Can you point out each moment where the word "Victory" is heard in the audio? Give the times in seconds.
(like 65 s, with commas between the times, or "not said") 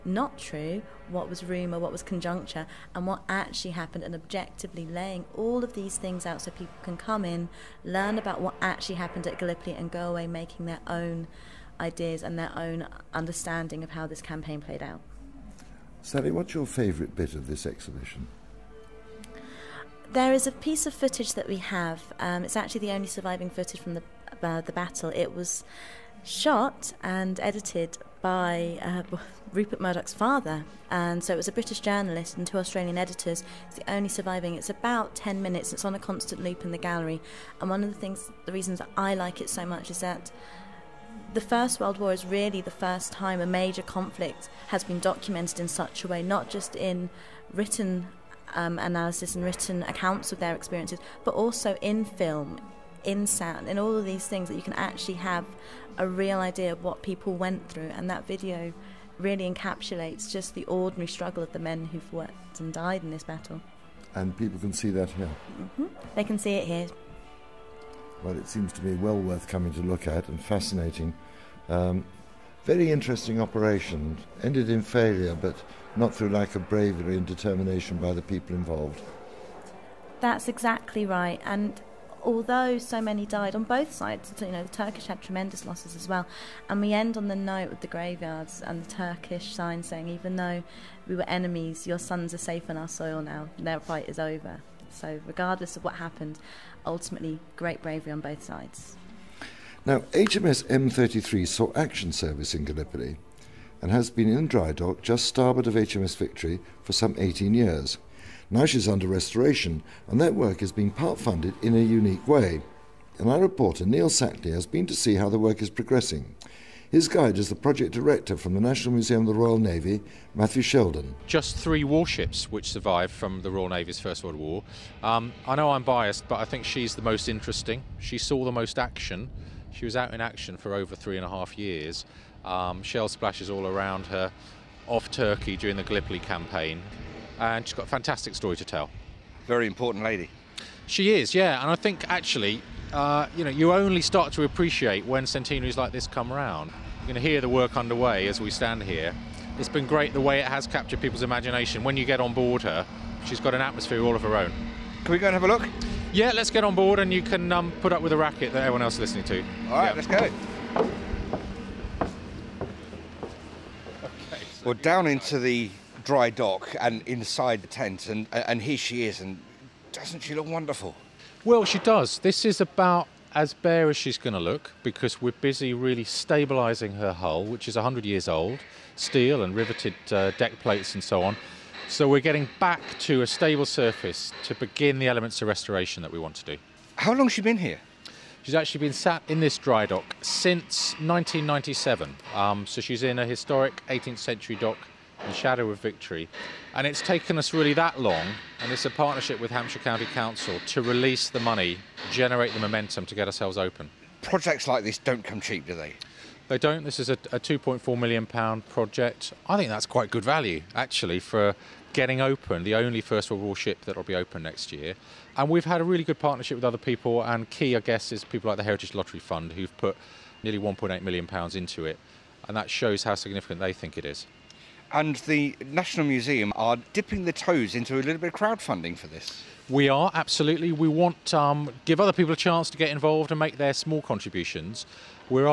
106 s, 195 s.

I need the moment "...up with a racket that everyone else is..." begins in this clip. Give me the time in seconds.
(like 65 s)
157 s.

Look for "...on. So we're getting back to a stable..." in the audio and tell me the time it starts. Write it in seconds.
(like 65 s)
181 s.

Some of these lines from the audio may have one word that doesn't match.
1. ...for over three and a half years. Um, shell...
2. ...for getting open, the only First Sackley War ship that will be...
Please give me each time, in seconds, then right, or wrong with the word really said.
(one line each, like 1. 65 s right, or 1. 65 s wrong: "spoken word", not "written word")
1. 130 s right
2. 211 s wrong: "World", not "Sackley".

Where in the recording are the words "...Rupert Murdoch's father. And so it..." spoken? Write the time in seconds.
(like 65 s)
29 s.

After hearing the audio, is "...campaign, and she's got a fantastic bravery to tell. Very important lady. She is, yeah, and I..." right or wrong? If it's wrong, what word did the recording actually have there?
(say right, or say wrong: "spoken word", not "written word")
wrong: "story", not "bravery".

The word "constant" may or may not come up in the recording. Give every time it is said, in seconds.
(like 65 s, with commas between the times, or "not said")
35 s.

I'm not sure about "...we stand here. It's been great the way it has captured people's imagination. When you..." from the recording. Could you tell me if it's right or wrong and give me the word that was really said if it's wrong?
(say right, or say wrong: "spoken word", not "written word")
right.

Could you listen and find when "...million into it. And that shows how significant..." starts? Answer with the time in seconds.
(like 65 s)
221 s.